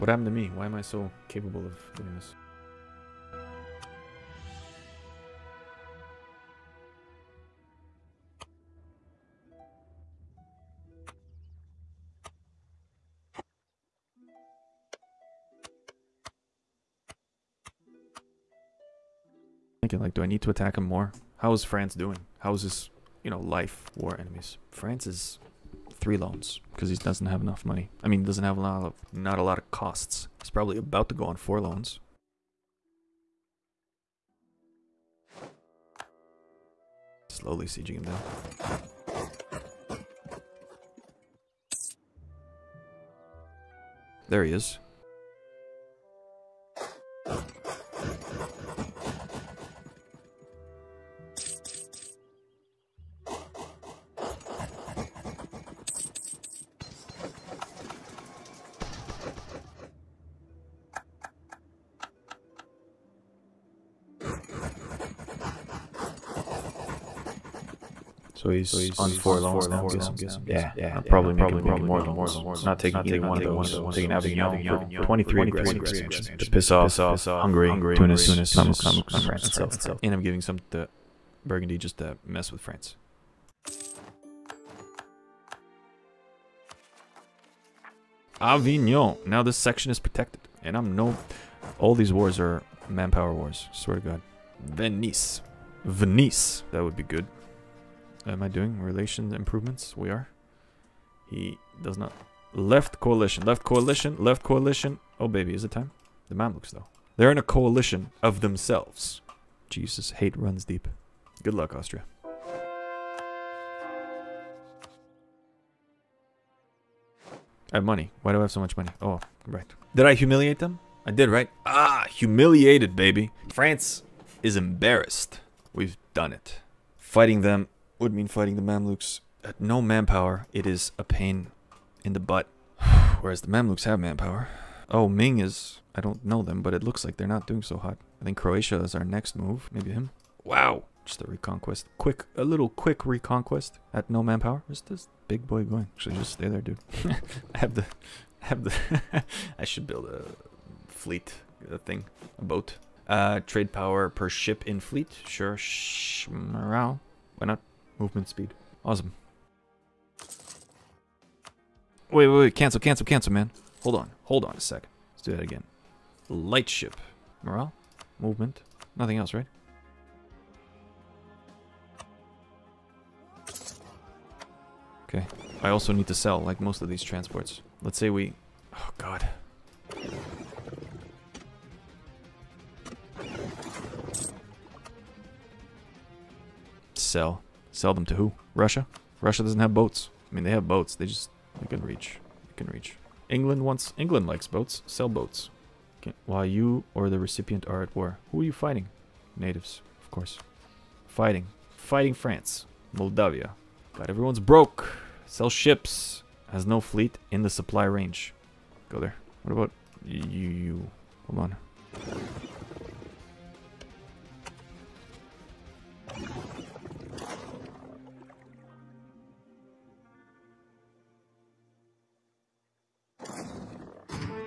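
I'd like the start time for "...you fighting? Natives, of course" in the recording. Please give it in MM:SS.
03:18.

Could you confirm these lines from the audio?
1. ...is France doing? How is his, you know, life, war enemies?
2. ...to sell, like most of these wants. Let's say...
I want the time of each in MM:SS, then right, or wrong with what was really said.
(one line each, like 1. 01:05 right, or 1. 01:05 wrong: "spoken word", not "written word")
1. 00:21 right
2. 02:56 wrong: "transports", not "wants".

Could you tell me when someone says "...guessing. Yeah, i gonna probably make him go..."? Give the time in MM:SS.
01:09.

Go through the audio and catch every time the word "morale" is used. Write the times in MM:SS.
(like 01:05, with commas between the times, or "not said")
02:36, 02:47.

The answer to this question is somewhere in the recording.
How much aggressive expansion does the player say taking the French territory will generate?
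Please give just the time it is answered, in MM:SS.
01:15.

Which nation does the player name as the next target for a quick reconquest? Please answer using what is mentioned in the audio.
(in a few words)
Croatia.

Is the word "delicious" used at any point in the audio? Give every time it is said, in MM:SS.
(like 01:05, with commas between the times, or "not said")
not said.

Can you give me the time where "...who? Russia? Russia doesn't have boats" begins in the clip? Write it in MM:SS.
03:08.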